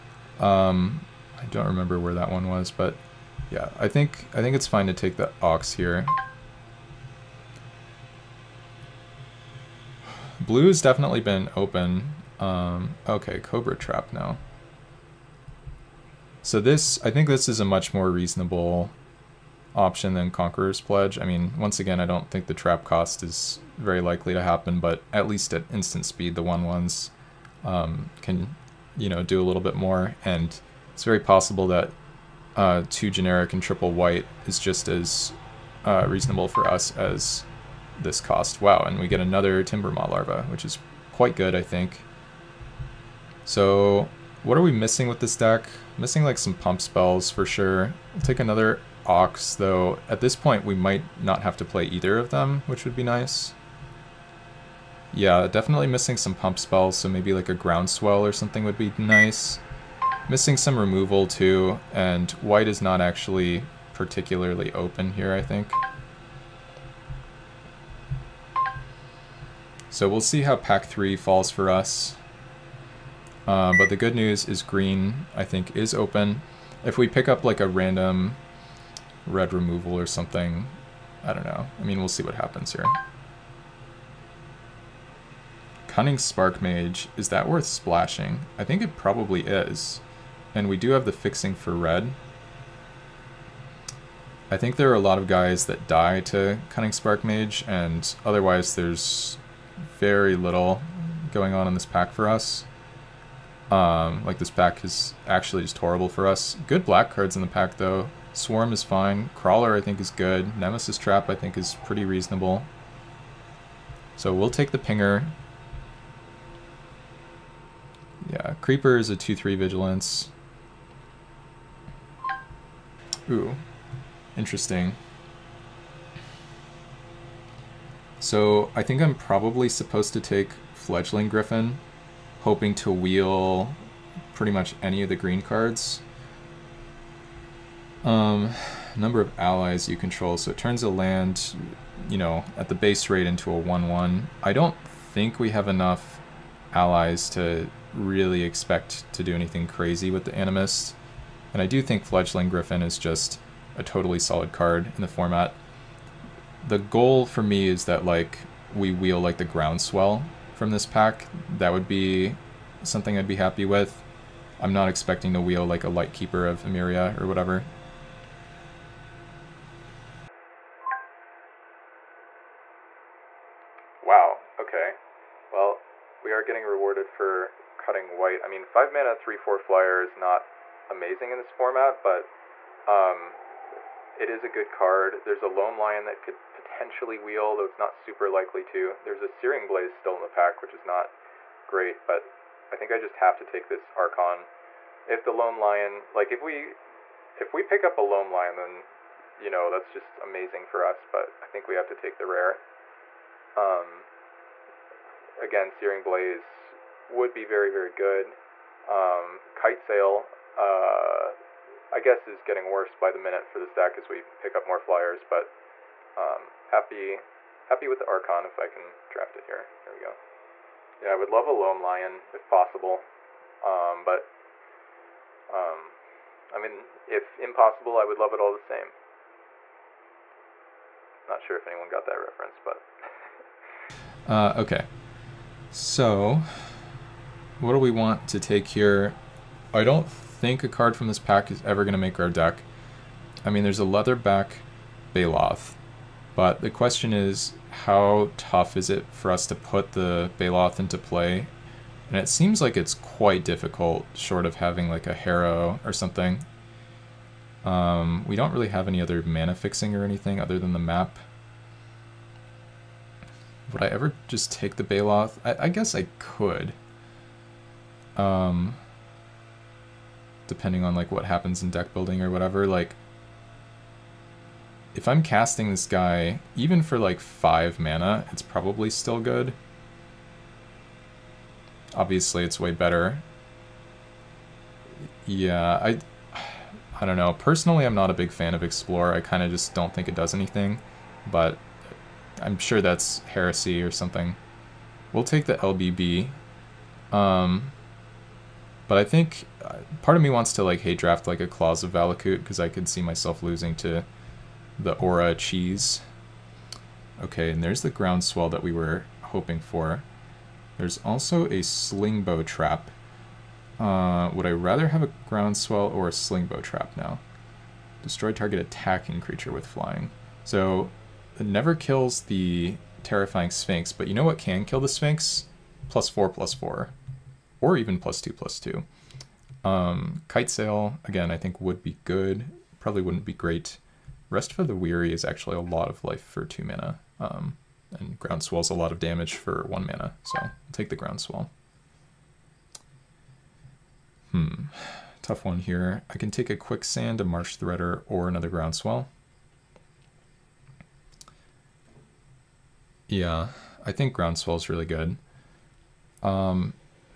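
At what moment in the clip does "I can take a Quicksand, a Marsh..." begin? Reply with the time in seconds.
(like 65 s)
346 s.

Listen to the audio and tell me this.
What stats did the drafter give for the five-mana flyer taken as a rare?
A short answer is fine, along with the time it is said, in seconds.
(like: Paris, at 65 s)
3-4 flyer, at 179 s.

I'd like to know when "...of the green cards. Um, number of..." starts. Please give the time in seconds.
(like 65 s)
135 s.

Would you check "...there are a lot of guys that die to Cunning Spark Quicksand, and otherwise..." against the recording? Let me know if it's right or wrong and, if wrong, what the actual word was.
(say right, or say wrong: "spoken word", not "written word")
wrong: "Mage", not "Quicksand".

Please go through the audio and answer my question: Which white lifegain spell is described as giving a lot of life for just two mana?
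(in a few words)
Rest for the Weary.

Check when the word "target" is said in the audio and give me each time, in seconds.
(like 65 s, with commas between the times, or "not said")
318 s.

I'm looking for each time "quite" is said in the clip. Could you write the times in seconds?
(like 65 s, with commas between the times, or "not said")
41 s, 252 s.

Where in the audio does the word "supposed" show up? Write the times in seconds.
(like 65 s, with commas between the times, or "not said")
129 s.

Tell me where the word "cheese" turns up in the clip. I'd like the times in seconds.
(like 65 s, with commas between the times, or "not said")
305 s.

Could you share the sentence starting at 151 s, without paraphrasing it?
And I do think Fledgling Griffin is just a totally solid card in the format.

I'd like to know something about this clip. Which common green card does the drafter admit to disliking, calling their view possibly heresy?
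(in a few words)
Explore.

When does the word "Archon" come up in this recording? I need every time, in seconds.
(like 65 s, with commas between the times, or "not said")
193 s, 218 s.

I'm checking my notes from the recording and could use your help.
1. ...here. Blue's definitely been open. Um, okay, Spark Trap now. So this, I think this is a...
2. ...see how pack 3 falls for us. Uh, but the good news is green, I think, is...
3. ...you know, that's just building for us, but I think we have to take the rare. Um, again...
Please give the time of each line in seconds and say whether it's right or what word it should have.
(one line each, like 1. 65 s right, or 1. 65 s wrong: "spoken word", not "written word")
1. 5 s wrong: "Cobra", not "Spark"
2. 70 s right
3. 199 s wrong: "amazing", not "building".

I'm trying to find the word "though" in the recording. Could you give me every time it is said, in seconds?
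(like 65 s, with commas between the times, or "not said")
49 s, 107 s, 187 s.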